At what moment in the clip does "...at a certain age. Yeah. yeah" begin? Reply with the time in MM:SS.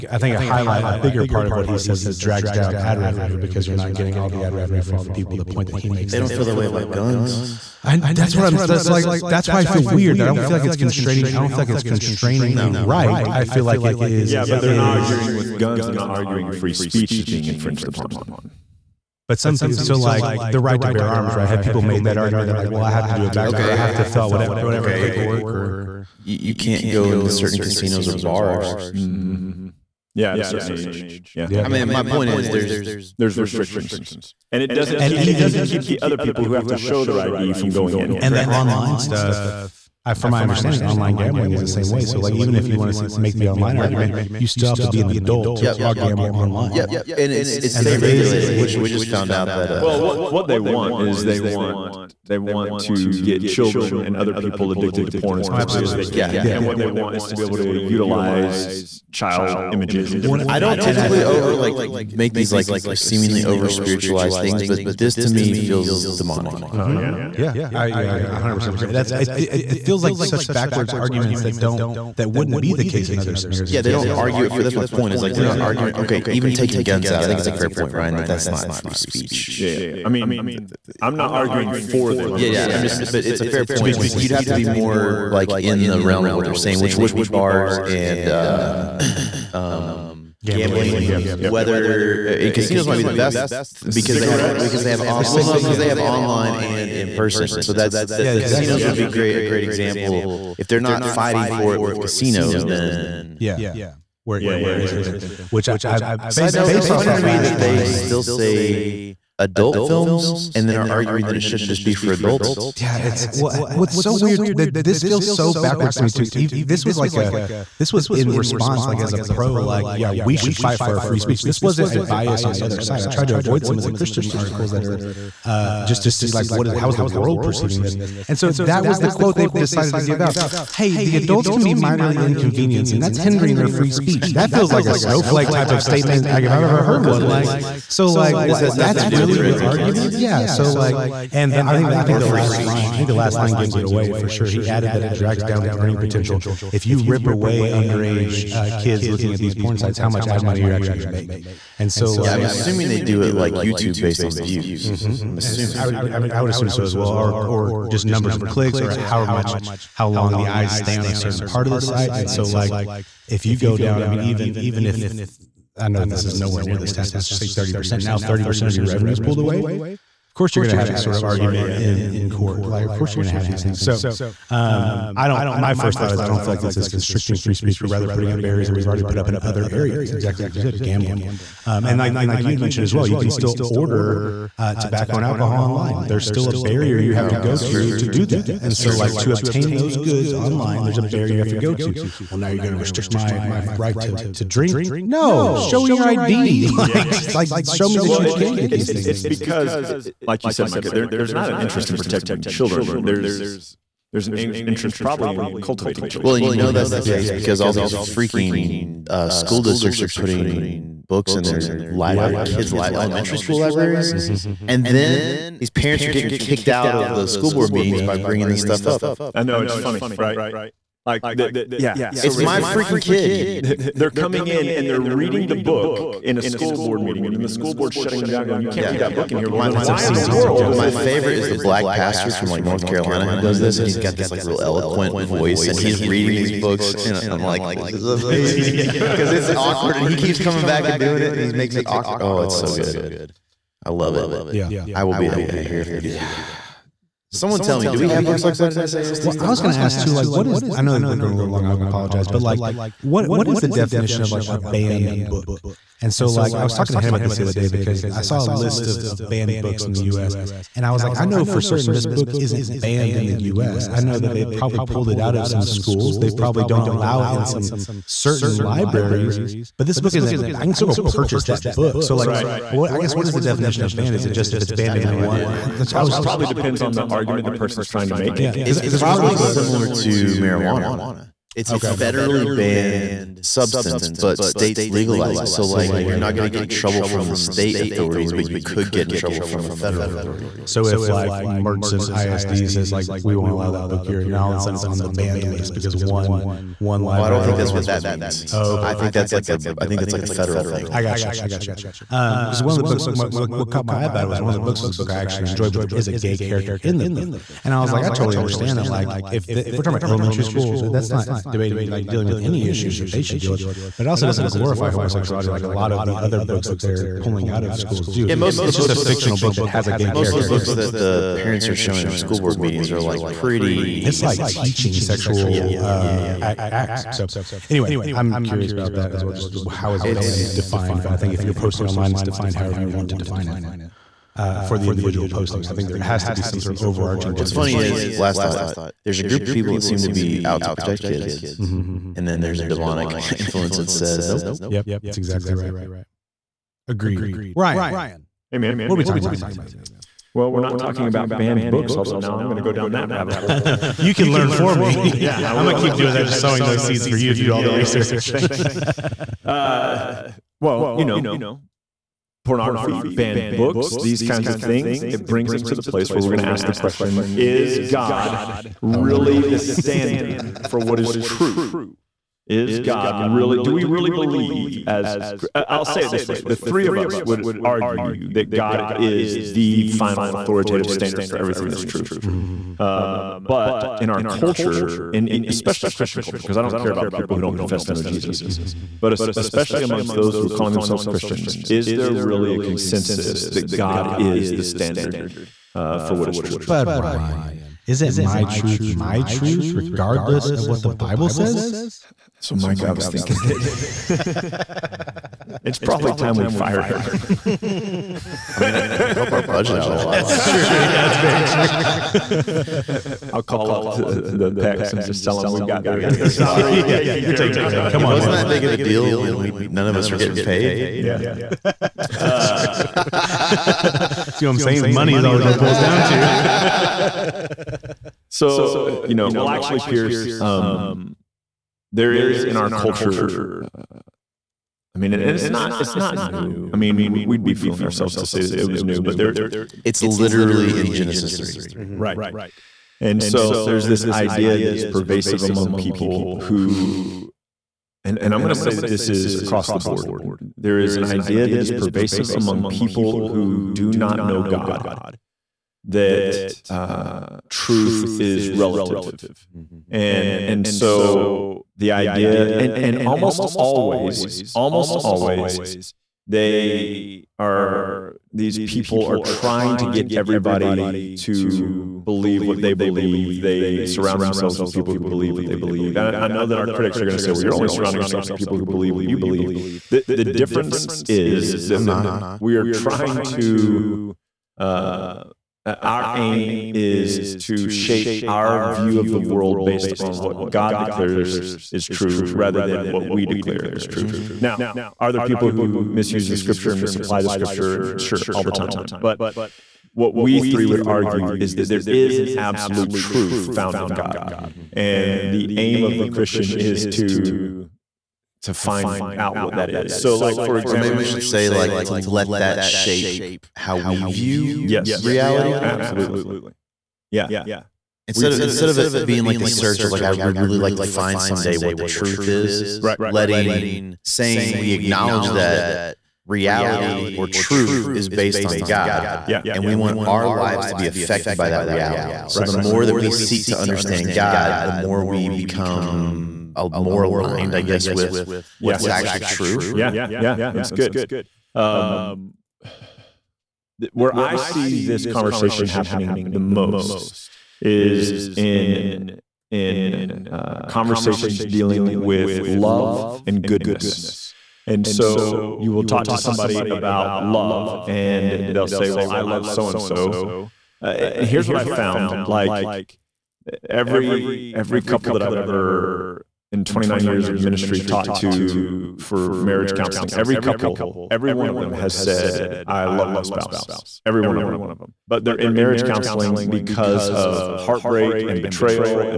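00:30.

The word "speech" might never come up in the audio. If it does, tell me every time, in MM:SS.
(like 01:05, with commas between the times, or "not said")
00:16, 01:18, 02:01, 02:13, 02:22, 02:57.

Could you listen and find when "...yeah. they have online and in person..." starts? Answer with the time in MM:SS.
01:35.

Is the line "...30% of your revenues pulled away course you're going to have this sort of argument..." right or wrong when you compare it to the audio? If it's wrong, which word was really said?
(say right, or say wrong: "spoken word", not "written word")
right.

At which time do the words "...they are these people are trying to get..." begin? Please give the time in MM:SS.
07:46.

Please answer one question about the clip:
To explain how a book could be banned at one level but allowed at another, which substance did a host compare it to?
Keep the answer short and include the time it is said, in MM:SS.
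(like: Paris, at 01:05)
Marijuana, at 04:40.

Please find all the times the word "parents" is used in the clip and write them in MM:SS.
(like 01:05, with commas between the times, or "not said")
03:35, 05:21.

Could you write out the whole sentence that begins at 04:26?
They probably don't allow it in some certain libraries.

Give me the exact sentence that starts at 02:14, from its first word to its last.
That feels like a snowflake type of statement like if I've ever heard well, one like is.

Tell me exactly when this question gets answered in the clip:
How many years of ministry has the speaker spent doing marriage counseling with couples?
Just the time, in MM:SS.
09:26.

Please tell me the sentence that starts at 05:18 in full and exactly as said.
Yeah, most of the it's books, just a fictional book that has a gay.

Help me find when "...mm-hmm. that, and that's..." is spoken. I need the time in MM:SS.
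03:08.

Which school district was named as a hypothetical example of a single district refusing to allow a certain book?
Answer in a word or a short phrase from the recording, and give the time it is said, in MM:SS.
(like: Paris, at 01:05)
Mertzen ISD, at 04:51.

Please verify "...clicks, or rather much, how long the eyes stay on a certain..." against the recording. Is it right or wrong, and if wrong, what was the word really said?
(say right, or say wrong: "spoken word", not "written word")
wrong: "however", not "rather".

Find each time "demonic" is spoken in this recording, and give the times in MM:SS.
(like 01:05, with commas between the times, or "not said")
01:06, 05:42.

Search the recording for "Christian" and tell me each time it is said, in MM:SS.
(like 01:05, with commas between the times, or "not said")
02:03, 06:25, 06:31, 08:26.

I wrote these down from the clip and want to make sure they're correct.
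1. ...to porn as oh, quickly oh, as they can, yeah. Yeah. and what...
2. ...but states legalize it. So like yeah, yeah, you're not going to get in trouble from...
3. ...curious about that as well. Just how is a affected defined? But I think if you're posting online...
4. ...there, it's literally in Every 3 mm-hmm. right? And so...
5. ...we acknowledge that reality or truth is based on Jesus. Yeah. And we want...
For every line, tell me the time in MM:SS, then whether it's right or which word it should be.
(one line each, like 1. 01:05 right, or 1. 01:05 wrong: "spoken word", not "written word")
1. 00:55 right
2. 04:44 right
3. 05:28 wrong: "banned", not "affected"
4. 07:19 wrong: "Genesis", not "Every"
5. 08:44 wrong: "God", not "Jesus".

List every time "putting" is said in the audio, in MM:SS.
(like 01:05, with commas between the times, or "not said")
02:58, 03:30.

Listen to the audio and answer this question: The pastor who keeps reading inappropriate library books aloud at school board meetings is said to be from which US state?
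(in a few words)
North Carolina.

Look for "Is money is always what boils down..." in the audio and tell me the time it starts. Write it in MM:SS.
07:04.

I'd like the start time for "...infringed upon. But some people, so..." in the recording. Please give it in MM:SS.
00:17.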